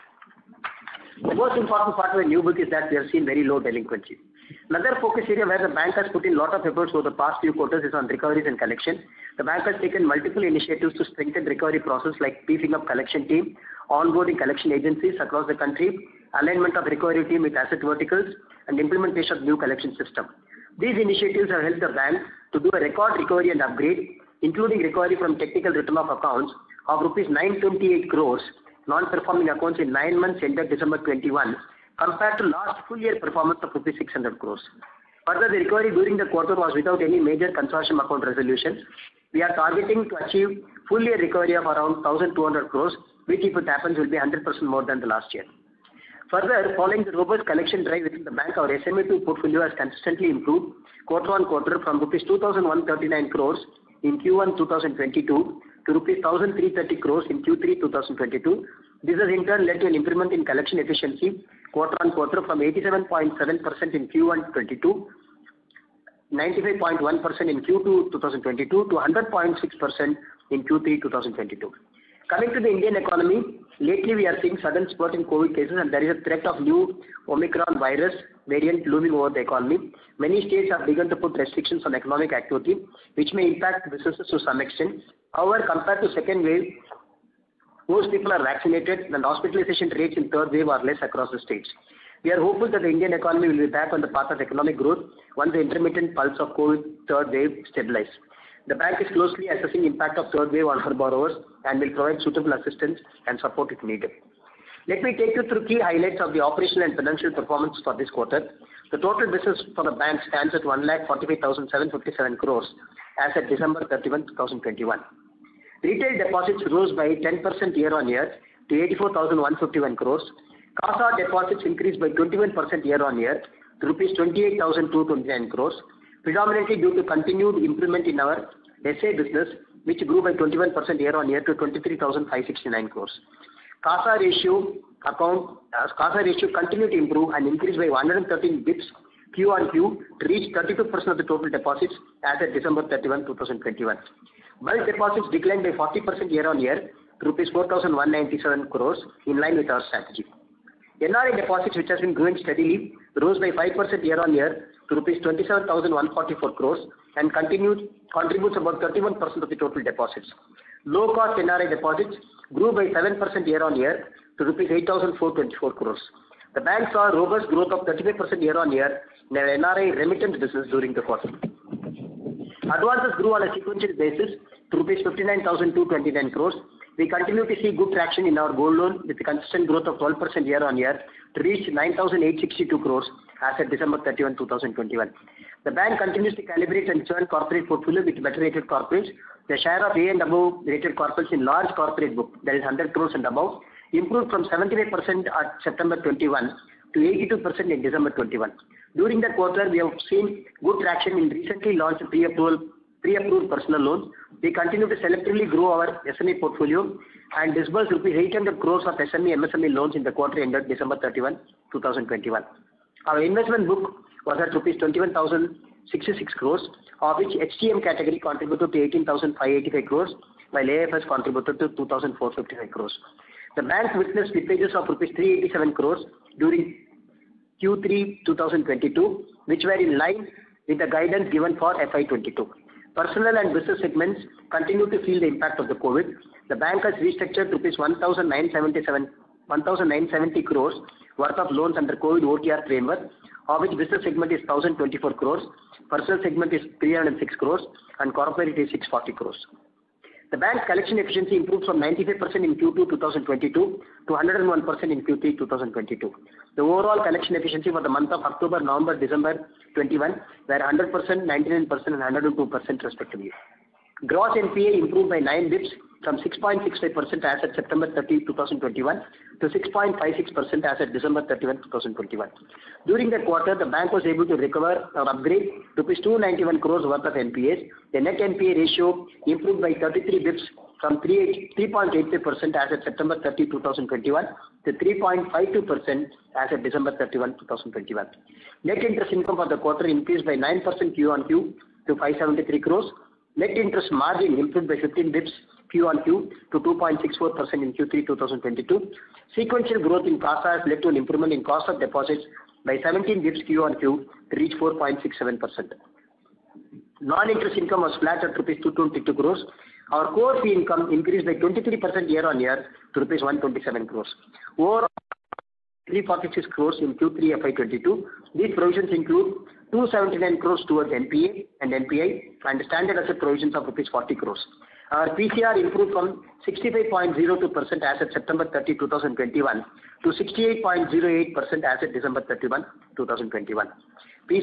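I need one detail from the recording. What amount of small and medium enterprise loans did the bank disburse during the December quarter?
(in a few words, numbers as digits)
800 crores.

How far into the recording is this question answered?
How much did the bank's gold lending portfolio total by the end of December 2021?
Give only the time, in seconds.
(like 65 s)
181 s.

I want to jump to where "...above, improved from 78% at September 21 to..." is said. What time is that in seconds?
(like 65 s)
193 s.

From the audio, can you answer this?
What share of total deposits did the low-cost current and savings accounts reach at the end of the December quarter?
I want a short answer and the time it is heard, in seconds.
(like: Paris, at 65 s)
32%, at 140 s.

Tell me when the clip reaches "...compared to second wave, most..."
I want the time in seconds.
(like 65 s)
85 s.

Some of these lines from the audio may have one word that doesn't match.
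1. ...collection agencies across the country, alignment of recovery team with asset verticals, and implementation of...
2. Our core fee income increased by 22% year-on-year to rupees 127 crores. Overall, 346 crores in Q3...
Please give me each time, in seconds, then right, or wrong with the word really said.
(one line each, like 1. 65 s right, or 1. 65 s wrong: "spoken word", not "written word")
1. 14 s right
2. 309 s wrong: "23", not "22".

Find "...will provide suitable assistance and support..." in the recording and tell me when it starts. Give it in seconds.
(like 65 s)
101 s.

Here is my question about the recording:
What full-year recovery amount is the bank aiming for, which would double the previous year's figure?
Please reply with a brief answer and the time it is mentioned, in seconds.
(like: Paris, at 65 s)
1,200 crores, at 42 s.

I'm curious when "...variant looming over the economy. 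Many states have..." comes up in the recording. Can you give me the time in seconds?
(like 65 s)
78 s.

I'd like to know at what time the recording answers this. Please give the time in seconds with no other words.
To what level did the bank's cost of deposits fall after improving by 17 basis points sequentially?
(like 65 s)
304 s.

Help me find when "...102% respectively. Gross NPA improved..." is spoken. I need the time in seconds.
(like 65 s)
262 s.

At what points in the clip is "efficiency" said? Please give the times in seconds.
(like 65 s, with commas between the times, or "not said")
250 s, 257 s.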